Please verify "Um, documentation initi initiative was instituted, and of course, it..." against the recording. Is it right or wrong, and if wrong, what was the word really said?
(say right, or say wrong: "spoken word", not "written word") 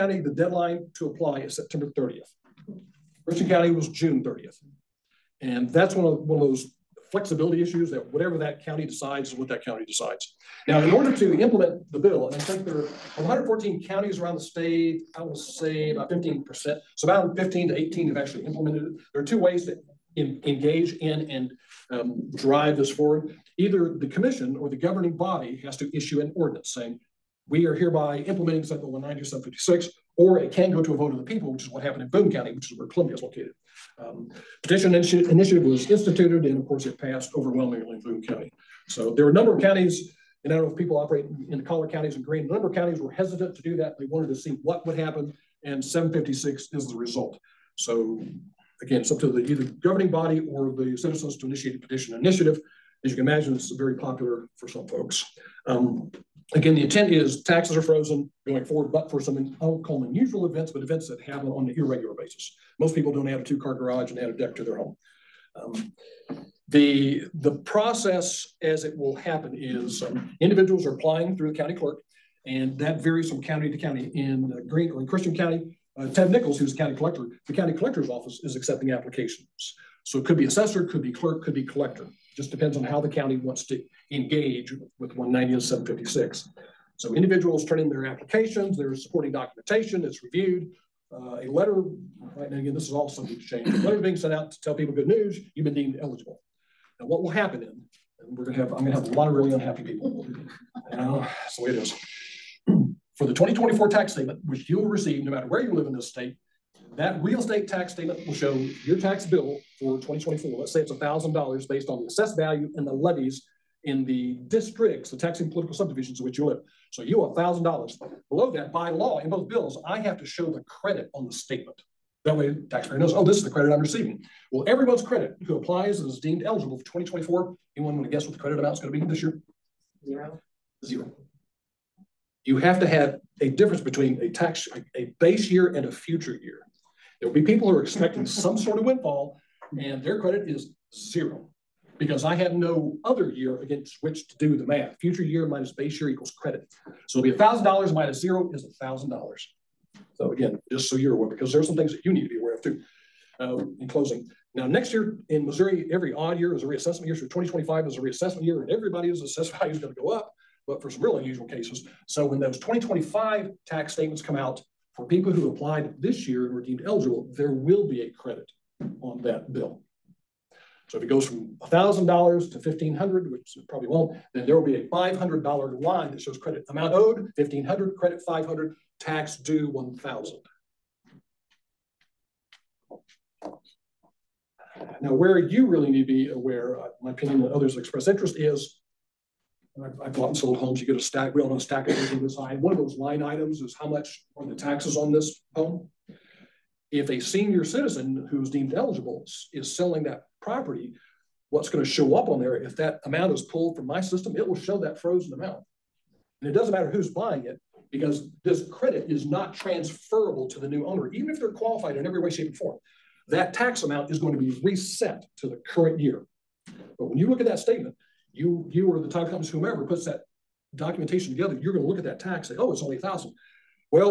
wrong: "petition", not "documentation".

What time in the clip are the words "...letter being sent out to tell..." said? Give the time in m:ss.
1:33.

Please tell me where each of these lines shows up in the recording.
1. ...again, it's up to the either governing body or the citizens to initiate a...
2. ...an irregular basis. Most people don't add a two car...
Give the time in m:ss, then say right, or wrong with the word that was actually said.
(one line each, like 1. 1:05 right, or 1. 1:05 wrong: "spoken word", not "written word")
1. 0:48 right
2. 1:01 right.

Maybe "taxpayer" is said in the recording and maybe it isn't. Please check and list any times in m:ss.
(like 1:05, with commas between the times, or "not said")
2:02.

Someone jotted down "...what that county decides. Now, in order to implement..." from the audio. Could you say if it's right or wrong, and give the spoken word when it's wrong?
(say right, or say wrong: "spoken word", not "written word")
right.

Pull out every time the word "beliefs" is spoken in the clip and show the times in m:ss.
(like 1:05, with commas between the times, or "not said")
not said.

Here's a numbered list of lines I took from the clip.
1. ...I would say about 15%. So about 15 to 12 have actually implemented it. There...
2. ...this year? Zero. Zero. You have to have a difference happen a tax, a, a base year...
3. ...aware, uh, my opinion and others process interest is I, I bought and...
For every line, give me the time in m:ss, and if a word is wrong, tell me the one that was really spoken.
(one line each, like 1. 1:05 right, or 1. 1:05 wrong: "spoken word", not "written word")
1. 0:15 wrong: "18", not "12"
2. 2:09 wrong: "between", not "happen"
3. 3:06 wrong: "express", not "process".